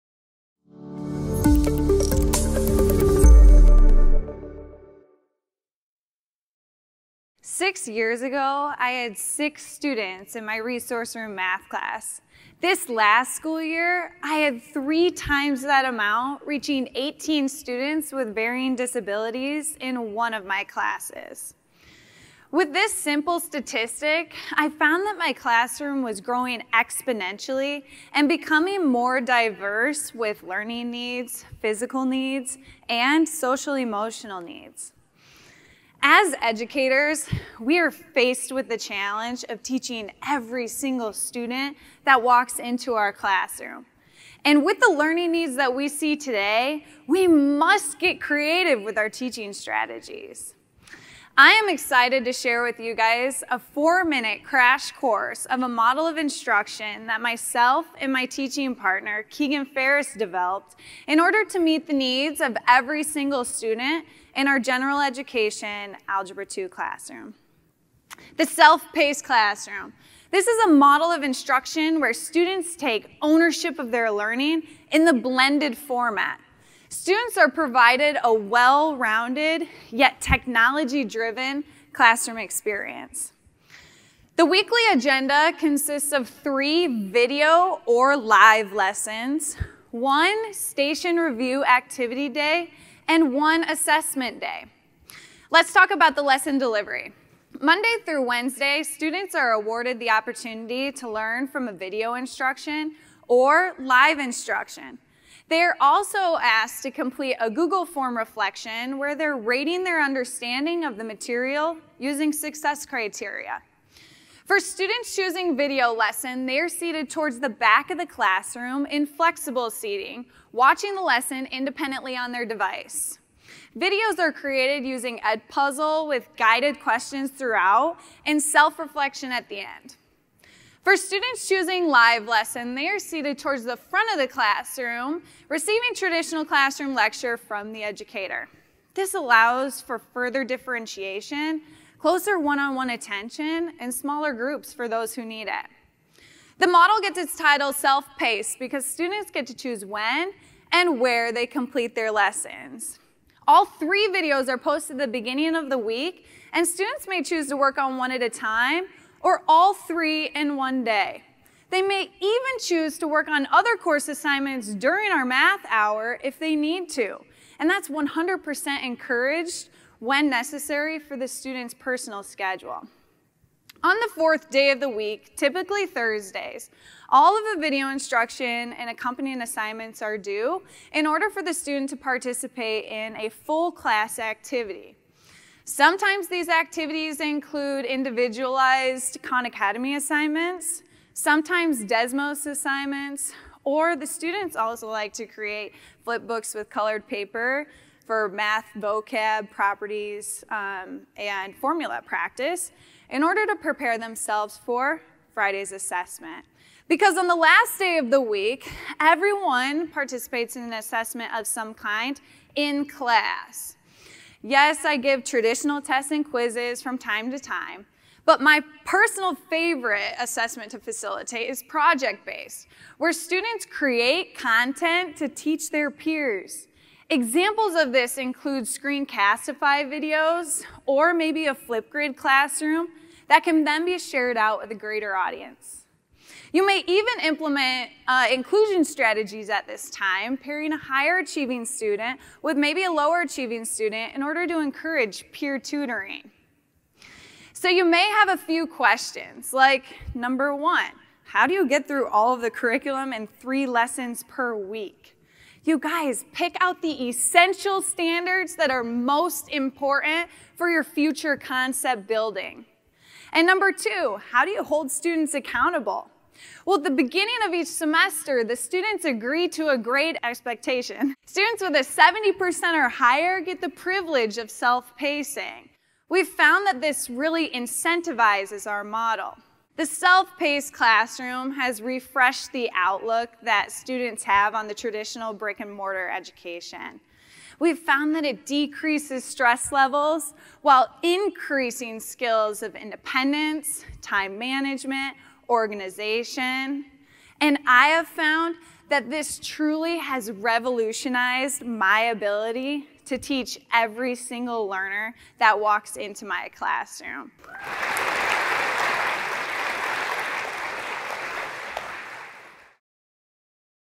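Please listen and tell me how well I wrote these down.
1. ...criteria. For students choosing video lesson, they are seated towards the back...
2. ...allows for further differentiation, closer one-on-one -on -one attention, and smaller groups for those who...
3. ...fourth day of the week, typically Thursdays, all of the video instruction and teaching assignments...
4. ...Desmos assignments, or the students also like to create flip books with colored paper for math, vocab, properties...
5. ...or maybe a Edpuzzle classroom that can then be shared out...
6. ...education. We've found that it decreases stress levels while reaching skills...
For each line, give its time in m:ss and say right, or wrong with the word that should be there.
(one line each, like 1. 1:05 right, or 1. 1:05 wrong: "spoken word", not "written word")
1. 1:52 right
2. 2:19 right
3. 2:54 wrong: "accompanying", not "teaching"
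4. 3:11 right
5. 3:50 wrong: "Flipgrid", not "Edpuzzle"
6. 4:46 wrong: "increasing", not "reaching".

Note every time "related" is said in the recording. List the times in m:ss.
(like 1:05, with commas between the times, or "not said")
not said.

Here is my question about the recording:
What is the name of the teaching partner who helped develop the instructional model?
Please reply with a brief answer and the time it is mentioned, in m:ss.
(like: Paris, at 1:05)
Keegan Ferris, at 0:59.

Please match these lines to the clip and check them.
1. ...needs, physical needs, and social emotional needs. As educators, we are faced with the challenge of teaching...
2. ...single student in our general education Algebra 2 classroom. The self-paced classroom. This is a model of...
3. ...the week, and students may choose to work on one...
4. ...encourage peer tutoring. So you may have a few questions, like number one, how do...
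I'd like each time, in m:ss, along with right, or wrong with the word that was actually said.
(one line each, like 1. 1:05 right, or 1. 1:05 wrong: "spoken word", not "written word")
1. 0:30 right
2. 1:03 right
3. 2:35 right
4. 4:04 right.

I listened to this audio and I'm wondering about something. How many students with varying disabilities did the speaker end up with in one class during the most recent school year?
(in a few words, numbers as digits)
18.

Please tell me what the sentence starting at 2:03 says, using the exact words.
Videos are created using Edpuzzle with guided questions throughout and self-reflection at the end.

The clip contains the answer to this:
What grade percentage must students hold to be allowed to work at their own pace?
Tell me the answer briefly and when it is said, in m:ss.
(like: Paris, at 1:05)
70%, at 4:31.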